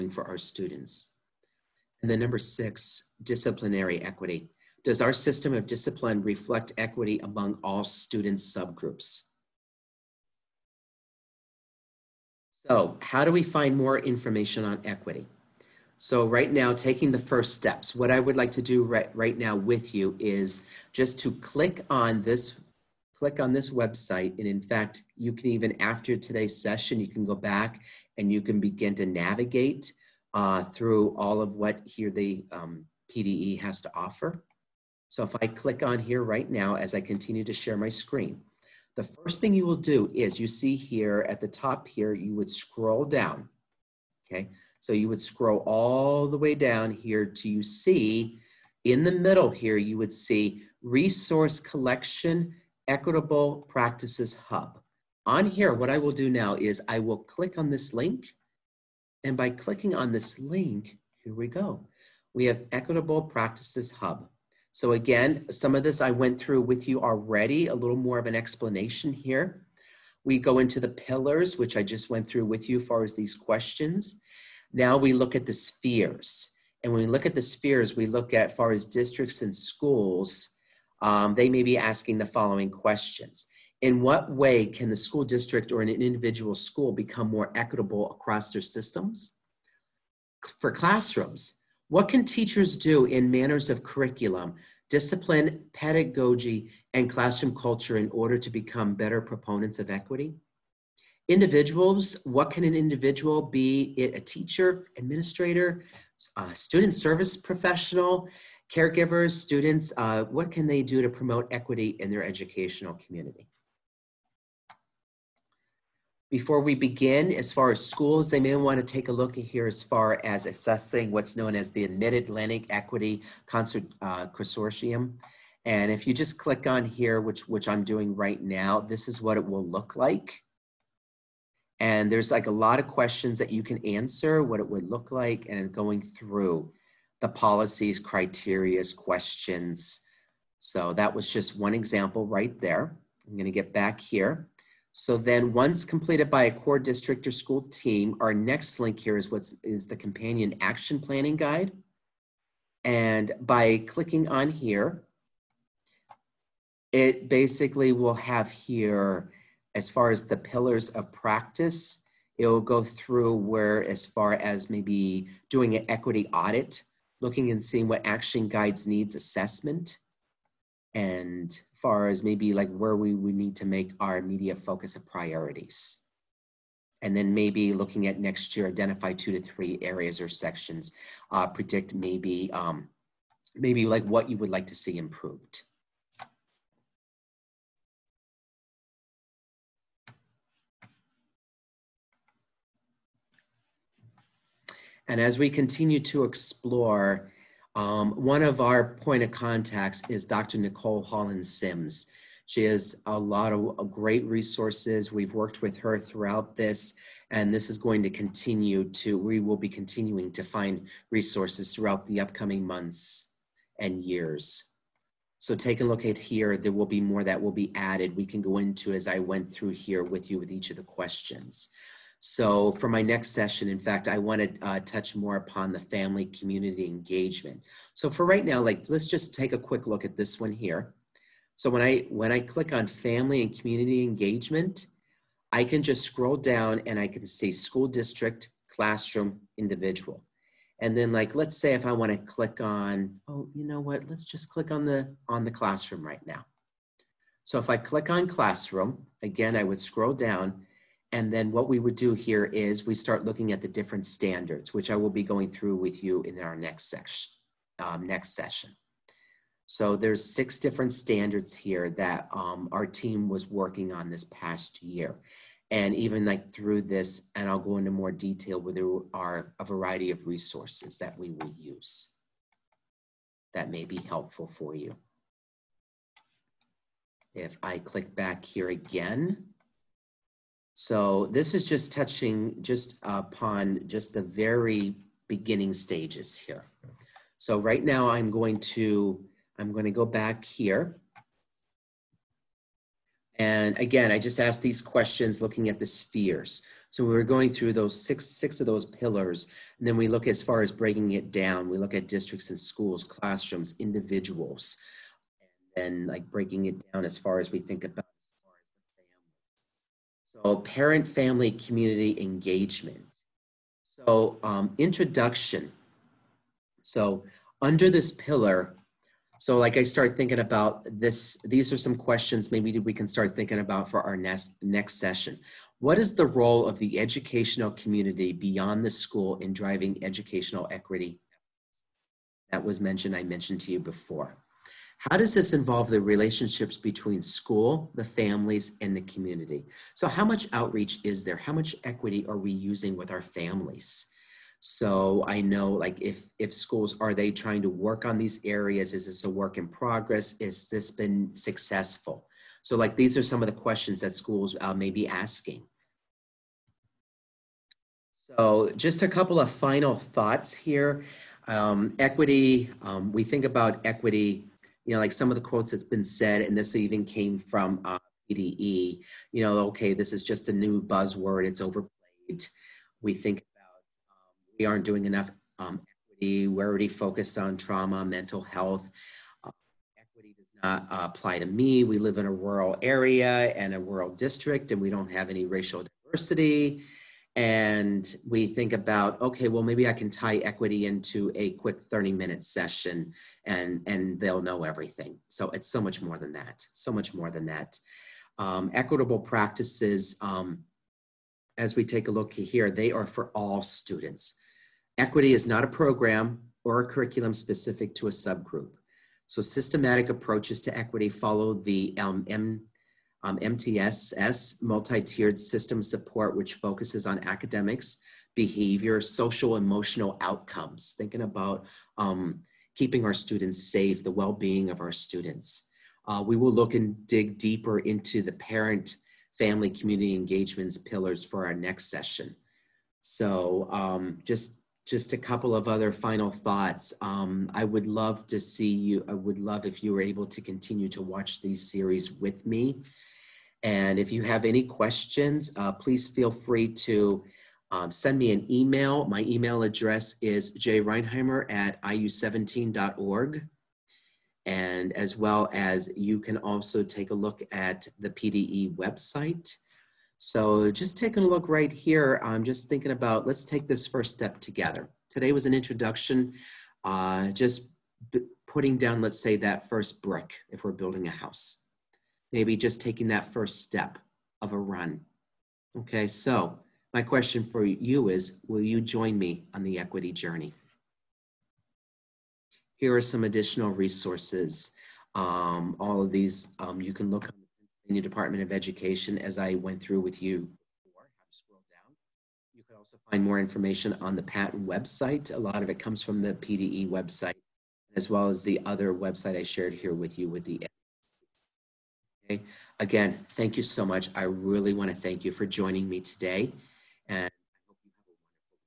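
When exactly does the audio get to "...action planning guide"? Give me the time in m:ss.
2:30.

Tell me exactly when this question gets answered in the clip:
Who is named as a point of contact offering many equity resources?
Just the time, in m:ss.
3:20.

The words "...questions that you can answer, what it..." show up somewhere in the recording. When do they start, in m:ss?
2:12.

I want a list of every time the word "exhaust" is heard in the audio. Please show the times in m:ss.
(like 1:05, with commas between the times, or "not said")
not said.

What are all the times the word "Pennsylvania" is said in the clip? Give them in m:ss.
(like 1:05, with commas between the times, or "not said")
8:07.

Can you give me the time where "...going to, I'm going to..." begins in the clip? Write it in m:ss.
4:48.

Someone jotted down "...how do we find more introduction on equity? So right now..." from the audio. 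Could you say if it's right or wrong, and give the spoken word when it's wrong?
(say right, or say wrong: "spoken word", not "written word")
wrong: "information", not "introduction".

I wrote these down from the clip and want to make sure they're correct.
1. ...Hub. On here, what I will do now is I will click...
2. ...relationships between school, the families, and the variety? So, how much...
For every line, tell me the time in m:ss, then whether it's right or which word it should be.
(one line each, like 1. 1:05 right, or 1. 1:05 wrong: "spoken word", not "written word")
1. 0:54 right
2. 5:36 wrong: "community", not "variety".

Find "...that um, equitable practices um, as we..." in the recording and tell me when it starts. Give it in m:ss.
6:37.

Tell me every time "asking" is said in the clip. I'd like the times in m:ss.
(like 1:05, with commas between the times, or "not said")
1:21, 5:55.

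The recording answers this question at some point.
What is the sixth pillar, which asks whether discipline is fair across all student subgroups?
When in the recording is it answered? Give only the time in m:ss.
0:03.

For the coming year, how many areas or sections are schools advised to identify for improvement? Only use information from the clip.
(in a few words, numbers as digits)
2 to 3.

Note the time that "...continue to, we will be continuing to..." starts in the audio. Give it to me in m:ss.
3:28.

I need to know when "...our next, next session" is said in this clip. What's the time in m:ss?
5:24.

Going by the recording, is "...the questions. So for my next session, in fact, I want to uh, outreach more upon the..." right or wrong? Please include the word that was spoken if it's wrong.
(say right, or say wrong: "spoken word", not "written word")
wrong: "touch", not "outreach".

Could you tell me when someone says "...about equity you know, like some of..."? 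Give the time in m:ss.
6:03.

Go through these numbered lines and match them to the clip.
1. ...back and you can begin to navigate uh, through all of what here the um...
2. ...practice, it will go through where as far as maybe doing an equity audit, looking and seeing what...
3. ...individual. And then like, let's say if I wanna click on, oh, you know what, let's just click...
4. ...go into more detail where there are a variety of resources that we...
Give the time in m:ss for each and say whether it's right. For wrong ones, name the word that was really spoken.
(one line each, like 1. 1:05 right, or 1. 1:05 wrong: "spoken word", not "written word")
1. 0:27 right
2. 2:41 right
3. 3:59 right
4. 4:27 right.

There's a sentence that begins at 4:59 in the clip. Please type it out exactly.
And then we look as far as breaking it down.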